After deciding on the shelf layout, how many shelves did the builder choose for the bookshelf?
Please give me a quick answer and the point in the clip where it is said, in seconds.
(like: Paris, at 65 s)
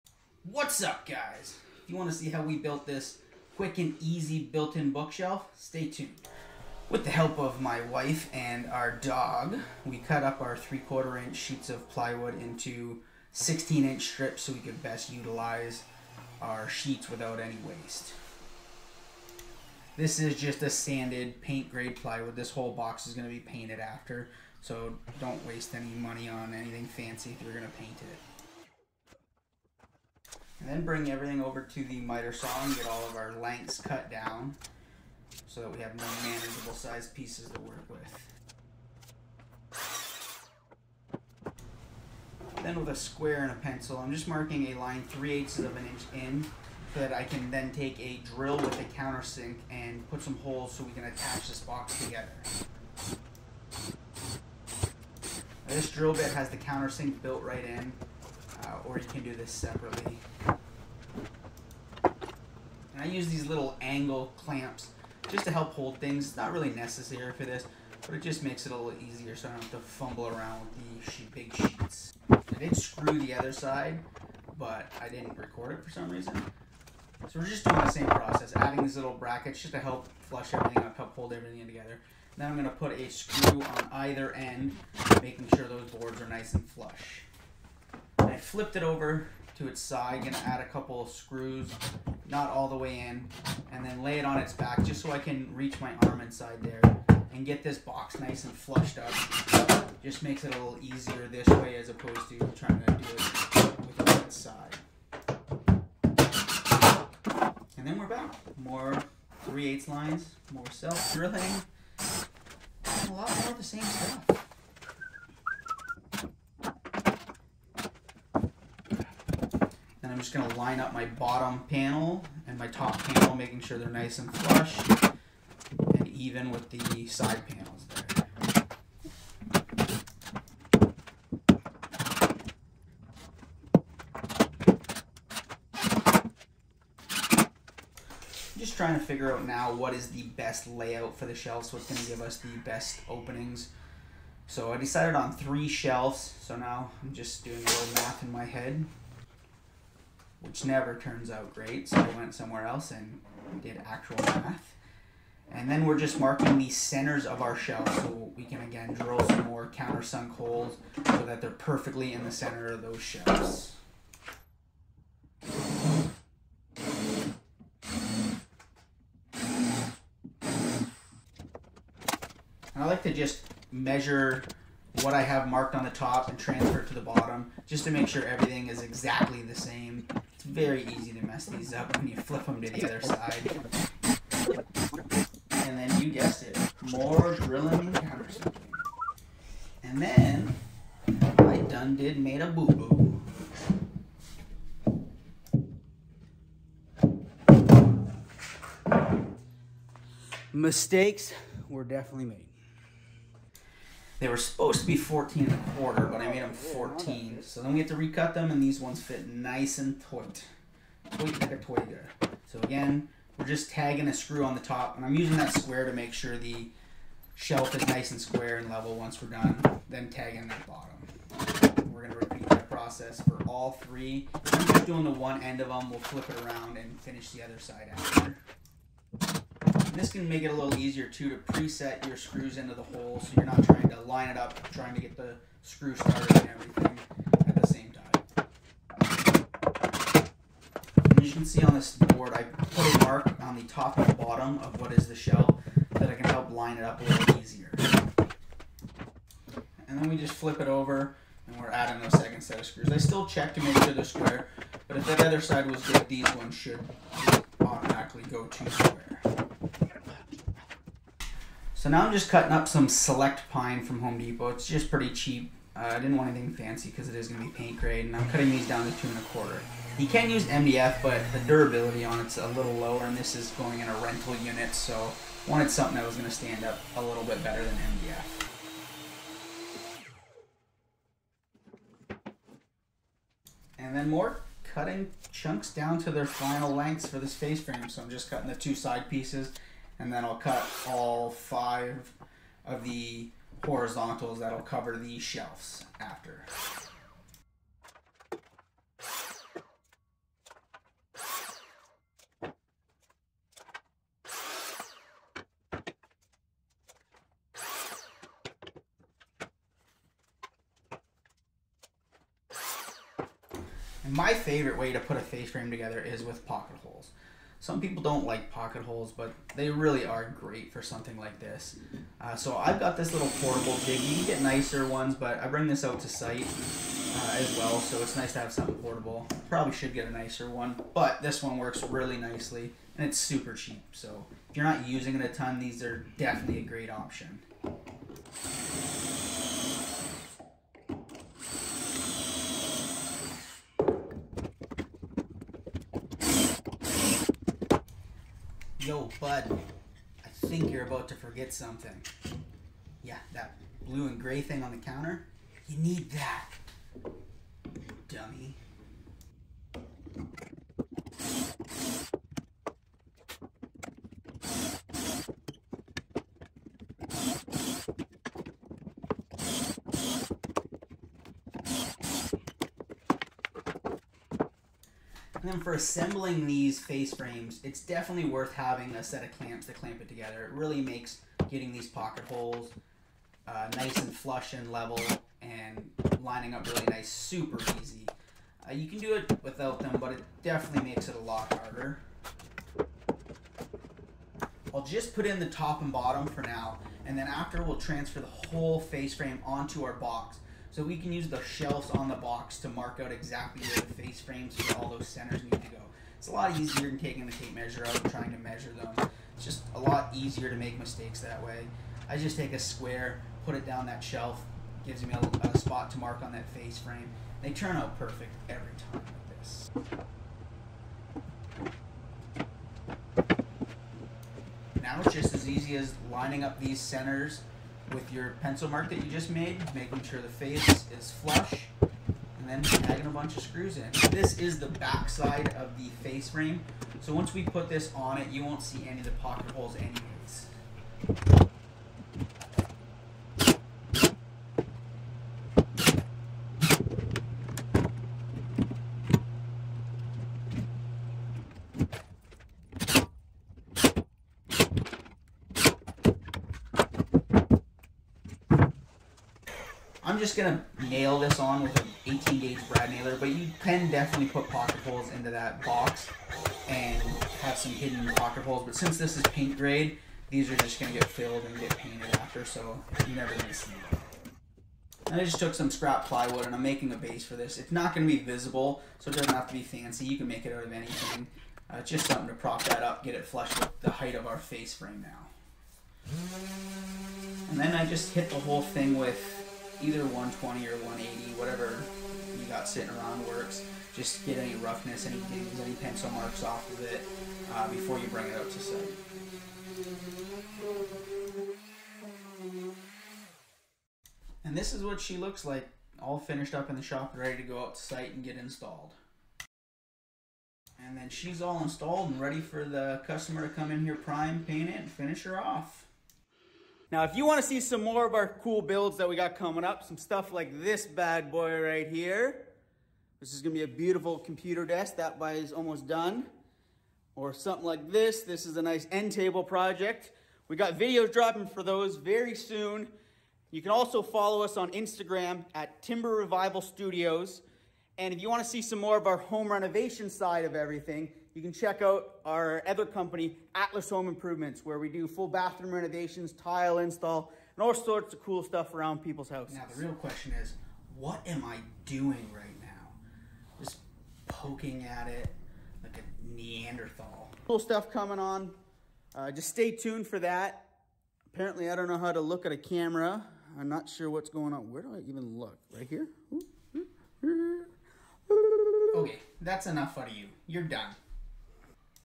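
3, at 145 s.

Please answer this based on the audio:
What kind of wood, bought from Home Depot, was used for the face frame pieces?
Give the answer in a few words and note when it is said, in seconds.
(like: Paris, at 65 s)
select pine, at 262 s.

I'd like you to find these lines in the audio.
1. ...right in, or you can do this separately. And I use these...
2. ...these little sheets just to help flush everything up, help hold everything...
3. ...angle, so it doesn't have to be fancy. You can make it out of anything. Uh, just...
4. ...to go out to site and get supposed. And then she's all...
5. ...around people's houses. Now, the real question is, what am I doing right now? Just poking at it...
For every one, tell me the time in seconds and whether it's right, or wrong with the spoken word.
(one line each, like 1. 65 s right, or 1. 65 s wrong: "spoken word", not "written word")
1. 57 s right
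2. 78 s wrong: "brackets", not "sheets"
3. 478 s wrong: "visible", not "angle"
4. 507 s wrong: "installed", not "supposed"
5. 548 s right.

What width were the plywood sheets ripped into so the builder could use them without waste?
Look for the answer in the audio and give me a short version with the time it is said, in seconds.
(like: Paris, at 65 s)
16 inch, at 13 s.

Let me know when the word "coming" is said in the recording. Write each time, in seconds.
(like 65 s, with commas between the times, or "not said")
519 s, 557 s.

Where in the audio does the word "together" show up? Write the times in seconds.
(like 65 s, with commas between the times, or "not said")
52 s, 81 s, 315 s, 380 s.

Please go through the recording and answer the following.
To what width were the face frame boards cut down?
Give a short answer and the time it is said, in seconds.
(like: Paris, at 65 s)
2 1/4, at 268 s.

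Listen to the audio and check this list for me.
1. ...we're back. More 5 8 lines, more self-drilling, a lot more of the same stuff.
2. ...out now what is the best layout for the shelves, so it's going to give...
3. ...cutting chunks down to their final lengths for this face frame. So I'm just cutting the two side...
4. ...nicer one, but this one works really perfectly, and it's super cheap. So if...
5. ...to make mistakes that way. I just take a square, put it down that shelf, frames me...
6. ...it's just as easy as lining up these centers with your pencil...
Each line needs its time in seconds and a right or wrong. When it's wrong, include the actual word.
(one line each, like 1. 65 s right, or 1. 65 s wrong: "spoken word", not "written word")
1. 107 s wrong: "3", not "5"
2. 139 s right
3. 284 s right
4. 330 s wrong: "nicely", not "perfectly"
5. 410 s wrong: "gives", not "frames"
6. 425 s right.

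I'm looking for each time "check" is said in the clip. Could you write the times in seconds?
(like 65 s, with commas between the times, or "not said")
253 s, 541 s.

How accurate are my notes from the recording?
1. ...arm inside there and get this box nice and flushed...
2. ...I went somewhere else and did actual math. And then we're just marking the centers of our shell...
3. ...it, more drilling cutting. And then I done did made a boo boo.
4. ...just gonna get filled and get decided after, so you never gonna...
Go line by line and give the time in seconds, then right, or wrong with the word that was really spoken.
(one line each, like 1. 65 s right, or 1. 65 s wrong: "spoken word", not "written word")
1. 96 s right
2. 151 s right
3. 186 s wrong: "countersinking", not "cutting"
4. 470 s wrong: "painted", not "decided".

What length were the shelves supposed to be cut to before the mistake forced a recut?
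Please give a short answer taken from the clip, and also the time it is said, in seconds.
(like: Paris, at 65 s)
14 1/4, at 204 s.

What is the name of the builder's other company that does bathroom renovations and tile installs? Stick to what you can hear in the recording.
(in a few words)
Atlas Home Improvements.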